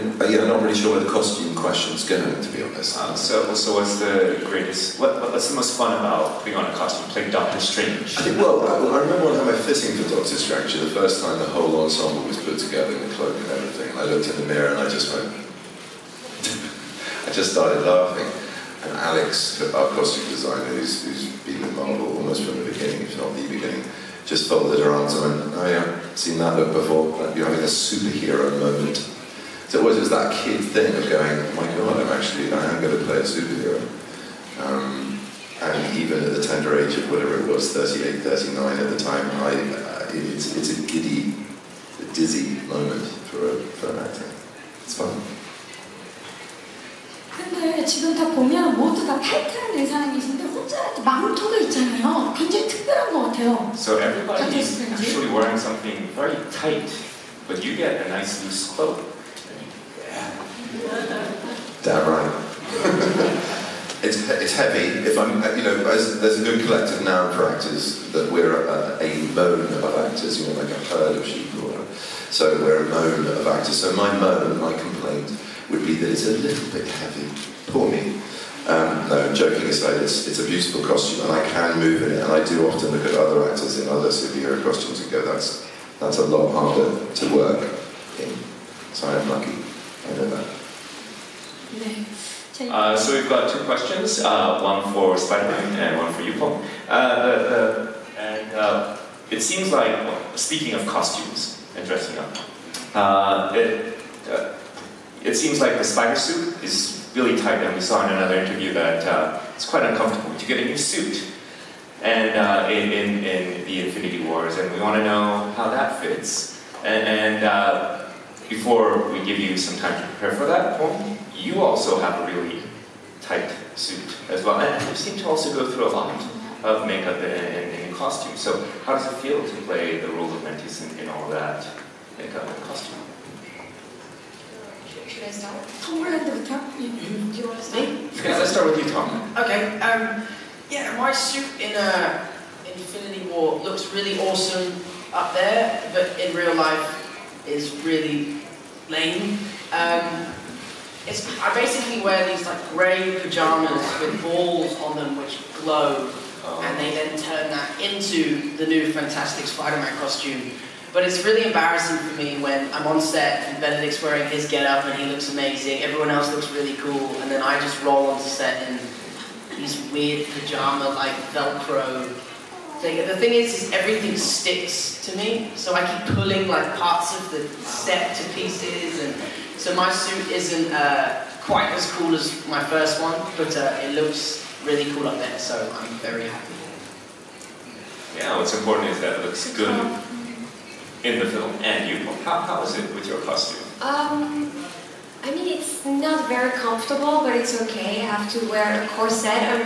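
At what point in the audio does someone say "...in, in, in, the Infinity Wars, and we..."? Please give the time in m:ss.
1:52.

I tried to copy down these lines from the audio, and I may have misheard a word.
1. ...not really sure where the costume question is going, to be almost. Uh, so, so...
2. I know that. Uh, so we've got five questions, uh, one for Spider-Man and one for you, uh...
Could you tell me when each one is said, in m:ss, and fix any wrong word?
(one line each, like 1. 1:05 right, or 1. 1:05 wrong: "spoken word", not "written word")
1. 0:00 wrong: "honest", not "almost"
2. 1:30 wrong: "two", not "five".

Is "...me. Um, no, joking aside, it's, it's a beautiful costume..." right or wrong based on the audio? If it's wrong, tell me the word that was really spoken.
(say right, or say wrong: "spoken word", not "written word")
right.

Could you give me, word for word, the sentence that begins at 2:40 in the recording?
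But it's really embarrassing for me when I'm on set and Benedict's wearing his get-up and he looks amazing.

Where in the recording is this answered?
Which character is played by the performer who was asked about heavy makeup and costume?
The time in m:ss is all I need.
2:10.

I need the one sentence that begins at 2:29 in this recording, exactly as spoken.
Um, it's, I basically wear these like grey pajamas with balls on them which glow, oh.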